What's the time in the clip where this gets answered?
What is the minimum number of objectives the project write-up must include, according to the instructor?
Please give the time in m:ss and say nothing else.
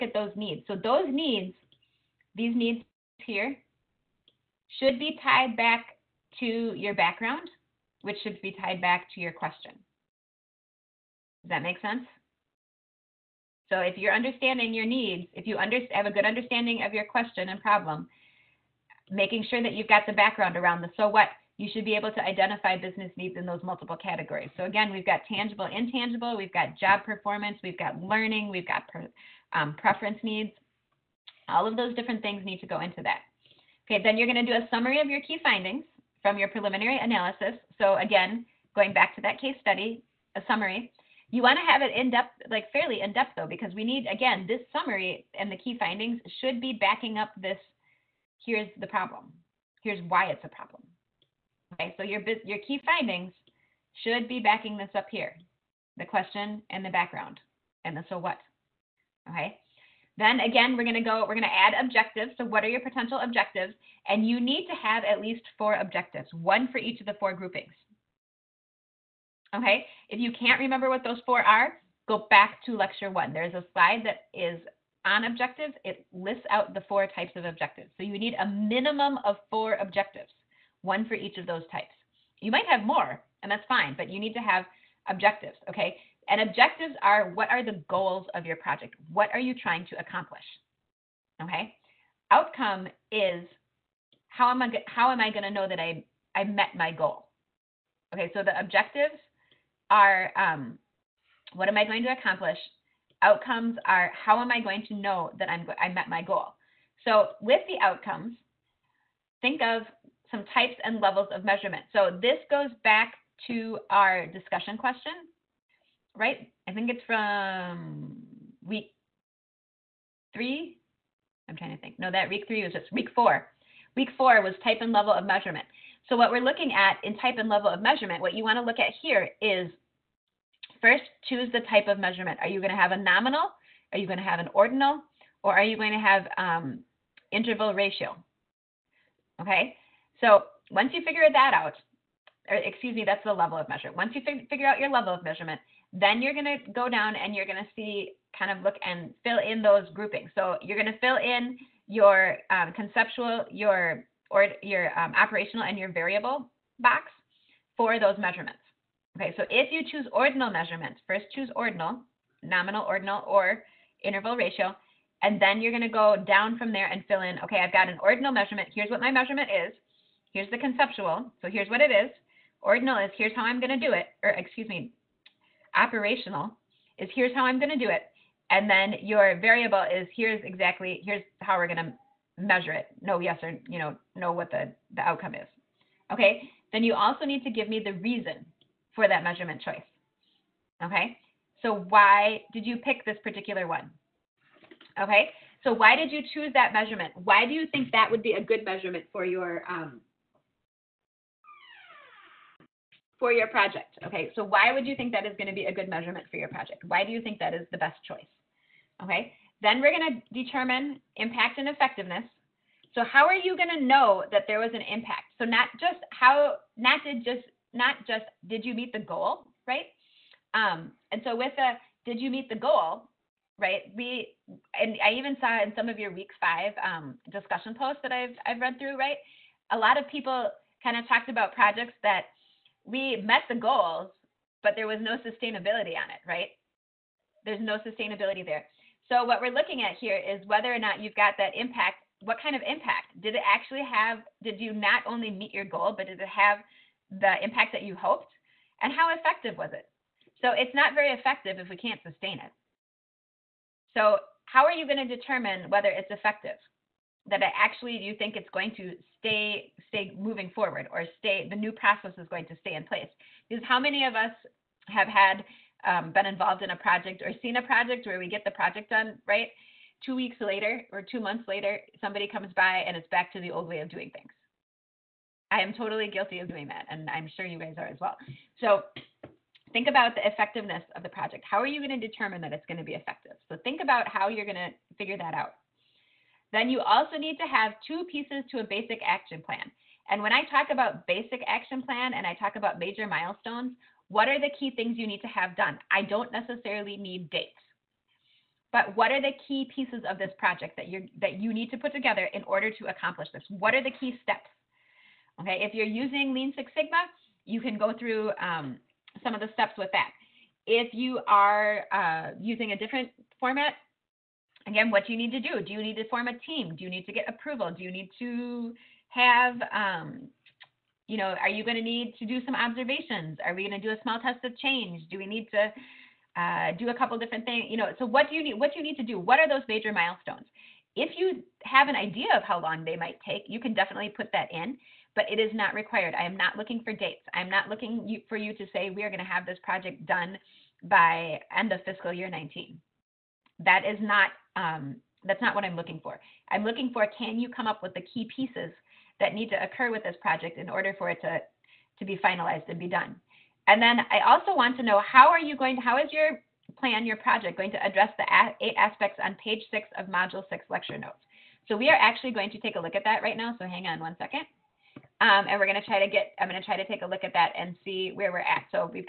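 1:18.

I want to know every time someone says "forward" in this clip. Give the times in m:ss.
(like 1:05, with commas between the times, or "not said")
4:20.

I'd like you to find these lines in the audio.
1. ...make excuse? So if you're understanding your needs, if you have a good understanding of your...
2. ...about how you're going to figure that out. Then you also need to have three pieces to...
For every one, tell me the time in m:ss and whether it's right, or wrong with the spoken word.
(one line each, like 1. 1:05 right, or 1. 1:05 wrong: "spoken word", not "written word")
1. 0:11 wrong: "sense", not "excuse"
2. 4:43 wrong: "two", not "three".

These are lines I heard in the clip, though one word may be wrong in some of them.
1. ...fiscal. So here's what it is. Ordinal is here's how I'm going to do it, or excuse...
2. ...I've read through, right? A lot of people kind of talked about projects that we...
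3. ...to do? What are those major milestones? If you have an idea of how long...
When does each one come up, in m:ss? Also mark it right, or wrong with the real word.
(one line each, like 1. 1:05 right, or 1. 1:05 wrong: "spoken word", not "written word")
1. 2:50 wrong: "conceptual", not "fiscal"
2. 3:48 right
3. 5:28 right.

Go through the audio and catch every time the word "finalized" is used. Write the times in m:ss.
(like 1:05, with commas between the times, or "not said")
5:52.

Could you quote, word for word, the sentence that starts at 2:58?
And then your variable is here's exactly, here's how we're going to measure it.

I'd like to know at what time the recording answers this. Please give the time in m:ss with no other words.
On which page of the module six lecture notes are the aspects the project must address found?
5:59.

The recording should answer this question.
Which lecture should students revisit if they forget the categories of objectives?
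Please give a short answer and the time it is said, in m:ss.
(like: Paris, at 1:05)
lecture one, at 1:12.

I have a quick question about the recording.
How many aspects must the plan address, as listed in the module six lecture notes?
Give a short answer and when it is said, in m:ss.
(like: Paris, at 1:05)
8, at 5:58.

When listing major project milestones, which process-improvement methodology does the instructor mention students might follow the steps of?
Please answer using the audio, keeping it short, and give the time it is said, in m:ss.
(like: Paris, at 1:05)
Lean Six Sigma, at 5:06.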